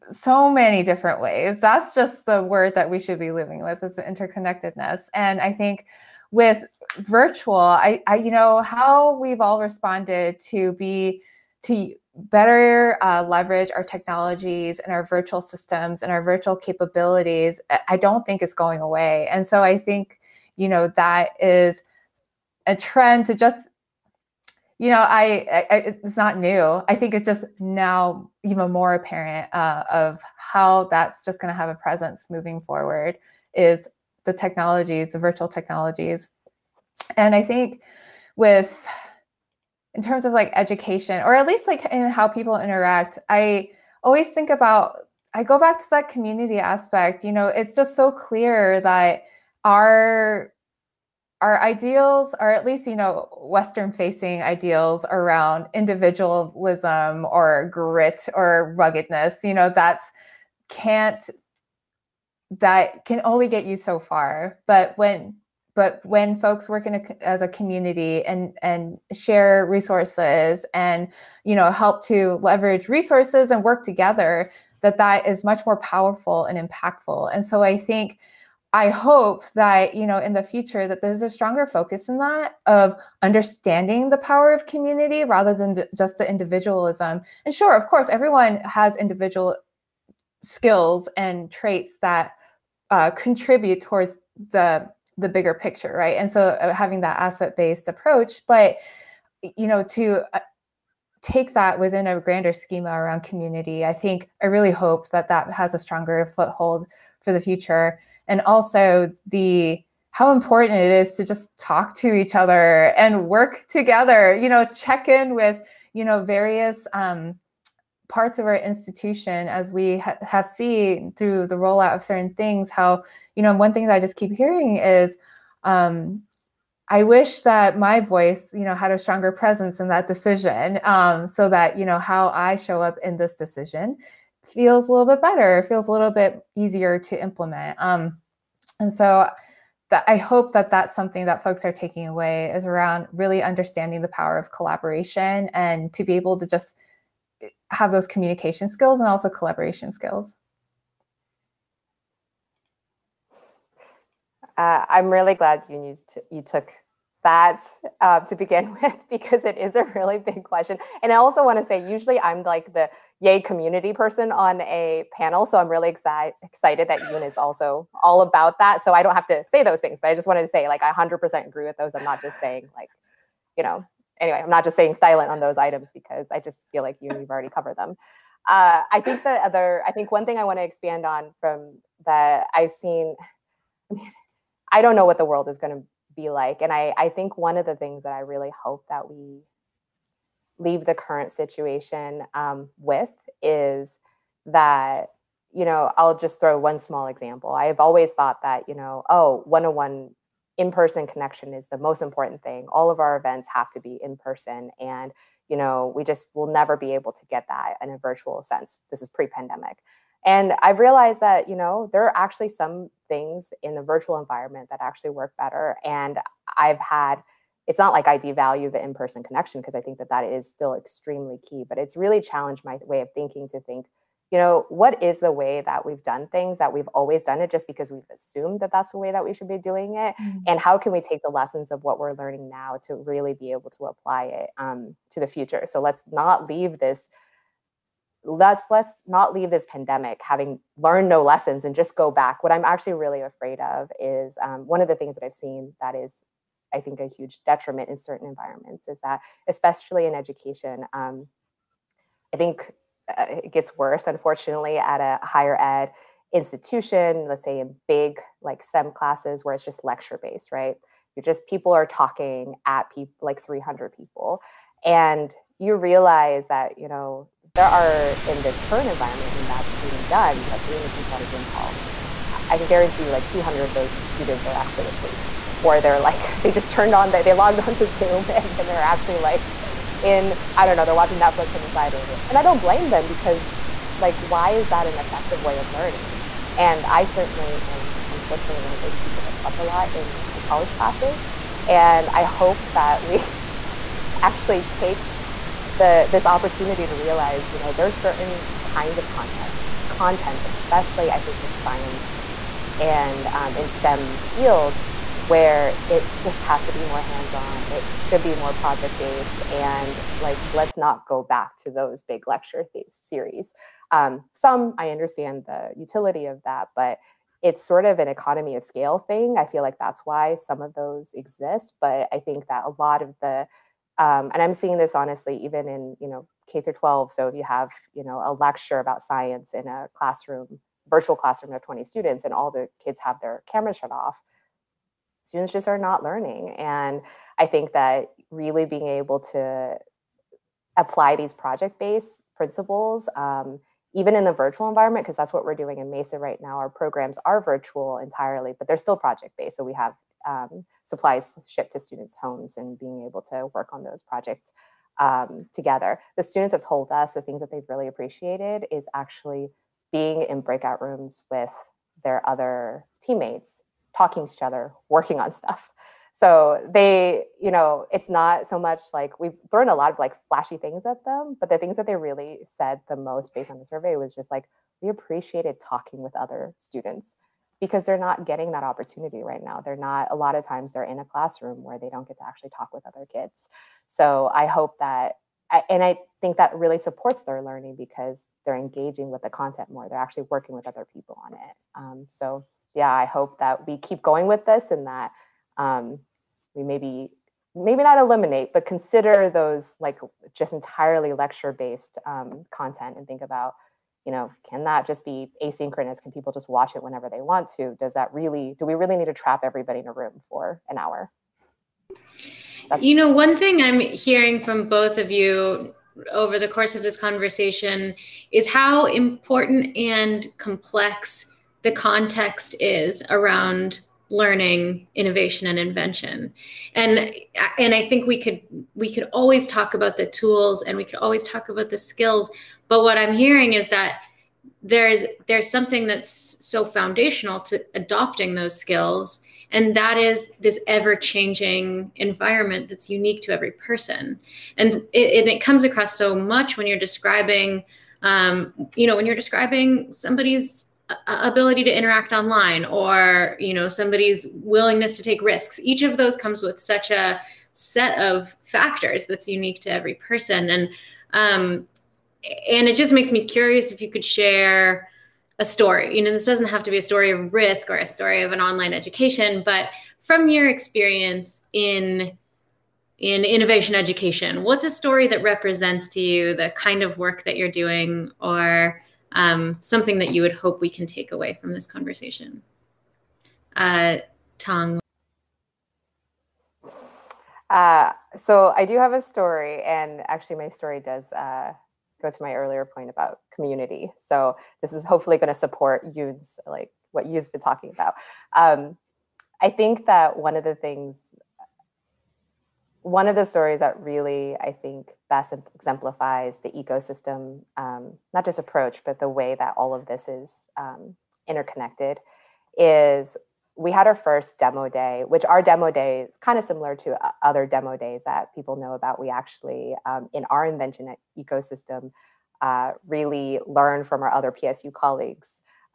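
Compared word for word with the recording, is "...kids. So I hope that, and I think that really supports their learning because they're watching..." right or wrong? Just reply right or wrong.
wrong.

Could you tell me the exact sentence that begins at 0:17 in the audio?
I don't think it's going away.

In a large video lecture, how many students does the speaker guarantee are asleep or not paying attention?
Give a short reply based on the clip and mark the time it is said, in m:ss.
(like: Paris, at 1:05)
200, at 4:33.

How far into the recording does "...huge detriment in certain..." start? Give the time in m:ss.
4:07.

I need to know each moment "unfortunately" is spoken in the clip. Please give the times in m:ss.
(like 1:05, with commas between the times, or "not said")
4:14, 4:48.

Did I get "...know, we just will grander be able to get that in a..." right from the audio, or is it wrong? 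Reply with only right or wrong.
wrong.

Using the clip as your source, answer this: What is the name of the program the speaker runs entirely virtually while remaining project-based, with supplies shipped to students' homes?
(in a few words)
MESA.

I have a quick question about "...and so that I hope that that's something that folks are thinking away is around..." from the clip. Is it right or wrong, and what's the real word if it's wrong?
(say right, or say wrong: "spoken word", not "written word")
wrong: "taking", not "thinking".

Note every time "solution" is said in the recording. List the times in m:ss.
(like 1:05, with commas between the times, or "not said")
not said.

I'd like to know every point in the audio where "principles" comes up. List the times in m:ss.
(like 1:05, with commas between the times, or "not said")
5:42.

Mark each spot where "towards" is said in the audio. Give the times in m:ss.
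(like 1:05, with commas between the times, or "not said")
1:33.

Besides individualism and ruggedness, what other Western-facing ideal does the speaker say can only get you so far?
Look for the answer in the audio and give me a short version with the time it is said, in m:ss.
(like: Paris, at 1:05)
Grit, at 0:57.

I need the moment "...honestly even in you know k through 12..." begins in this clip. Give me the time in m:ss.
5:24.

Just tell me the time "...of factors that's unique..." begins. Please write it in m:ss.
7:37.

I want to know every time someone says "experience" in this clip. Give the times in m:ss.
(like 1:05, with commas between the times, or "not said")
7:50.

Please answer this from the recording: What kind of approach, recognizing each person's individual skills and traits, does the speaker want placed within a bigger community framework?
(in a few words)
Asset-based approach.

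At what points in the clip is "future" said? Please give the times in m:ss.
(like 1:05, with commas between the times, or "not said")
1:20, 1:47, 3:55.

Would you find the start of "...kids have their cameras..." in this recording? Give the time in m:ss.
5:32.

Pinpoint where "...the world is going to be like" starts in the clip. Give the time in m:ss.
3:05.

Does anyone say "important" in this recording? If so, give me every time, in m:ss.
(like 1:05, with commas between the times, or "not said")
1:50, 3:22, 6:58.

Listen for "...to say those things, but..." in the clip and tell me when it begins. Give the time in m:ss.
2:49.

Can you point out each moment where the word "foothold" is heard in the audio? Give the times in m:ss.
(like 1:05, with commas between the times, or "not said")
1:46.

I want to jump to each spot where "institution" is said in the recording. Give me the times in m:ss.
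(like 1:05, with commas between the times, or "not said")
1:58, 4:16.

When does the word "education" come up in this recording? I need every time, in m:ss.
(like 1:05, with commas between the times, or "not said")
0:40, 4:10, 7:48, 7:53.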